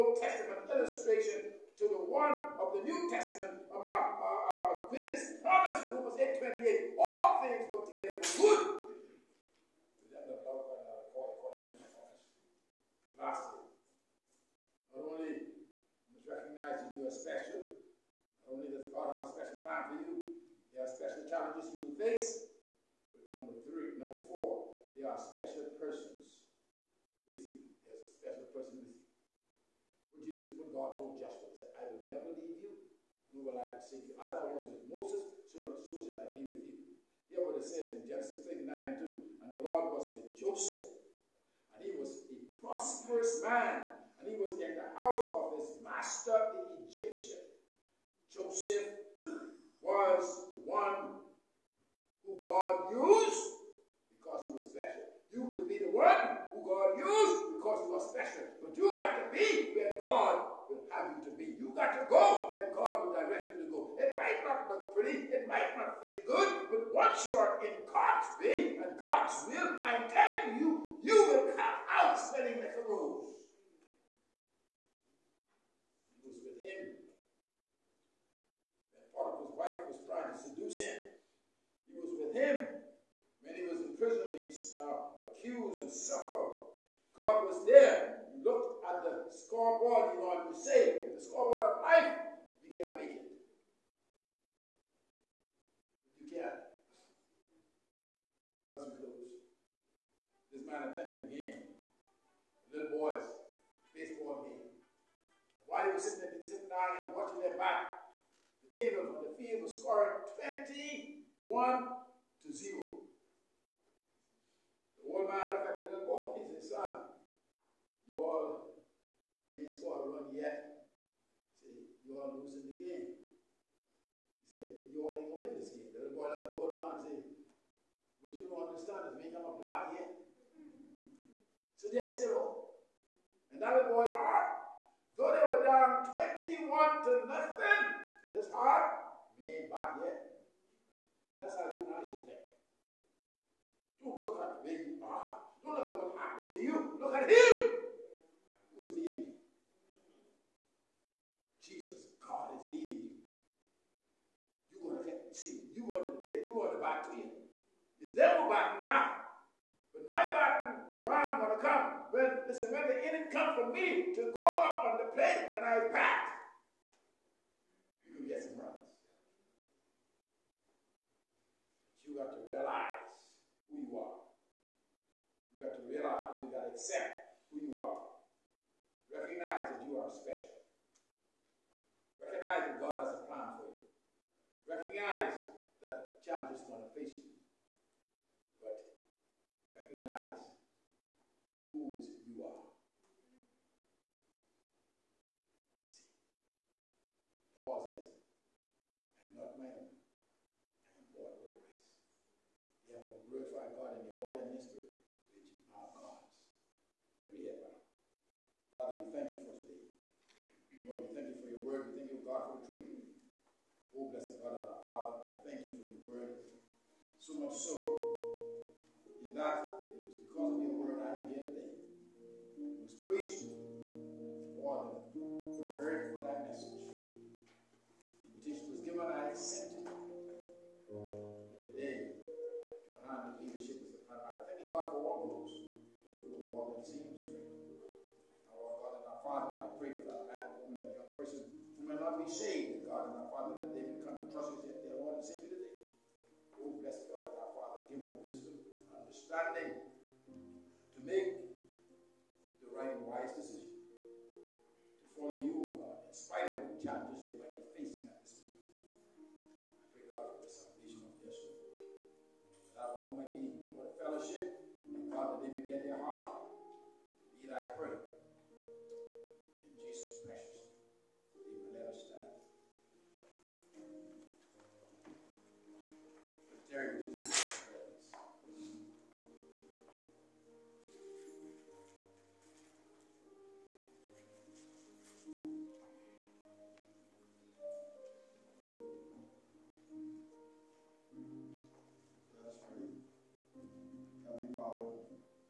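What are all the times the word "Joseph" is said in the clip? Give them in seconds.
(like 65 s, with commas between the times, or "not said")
40 s, 48 s.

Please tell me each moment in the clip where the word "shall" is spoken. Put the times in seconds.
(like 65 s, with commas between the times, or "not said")
36 s.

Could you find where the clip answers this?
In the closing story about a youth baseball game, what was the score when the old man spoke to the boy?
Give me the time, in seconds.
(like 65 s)
110 s.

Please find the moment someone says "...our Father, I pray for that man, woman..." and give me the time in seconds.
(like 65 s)
239 s.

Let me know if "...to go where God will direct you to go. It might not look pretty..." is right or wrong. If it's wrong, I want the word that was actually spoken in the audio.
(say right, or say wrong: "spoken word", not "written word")
right.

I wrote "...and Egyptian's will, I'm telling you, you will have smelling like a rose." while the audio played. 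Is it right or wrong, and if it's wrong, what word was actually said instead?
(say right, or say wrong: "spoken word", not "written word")
wrong: "God", not "Egyptian".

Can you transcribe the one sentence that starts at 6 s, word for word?
All things work together for good.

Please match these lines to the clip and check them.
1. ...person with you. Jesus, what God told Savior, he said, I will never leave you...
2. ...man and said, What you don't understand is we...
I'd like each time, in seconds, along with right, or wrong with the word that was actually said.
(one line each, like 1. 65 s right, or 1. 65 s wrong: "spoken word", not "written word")
1. 28 s wrong: "Joshua", not "Savior"
2. 126 s right.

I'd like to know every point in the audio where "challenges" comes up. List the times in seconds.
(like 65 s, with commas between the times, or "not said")
21 s, 186 s, 256 s.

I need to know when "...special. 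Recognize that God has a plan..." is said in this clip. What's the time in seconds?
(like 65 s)
180 s.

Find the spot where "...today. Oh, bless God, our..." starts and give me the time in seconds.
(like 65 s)
245 s.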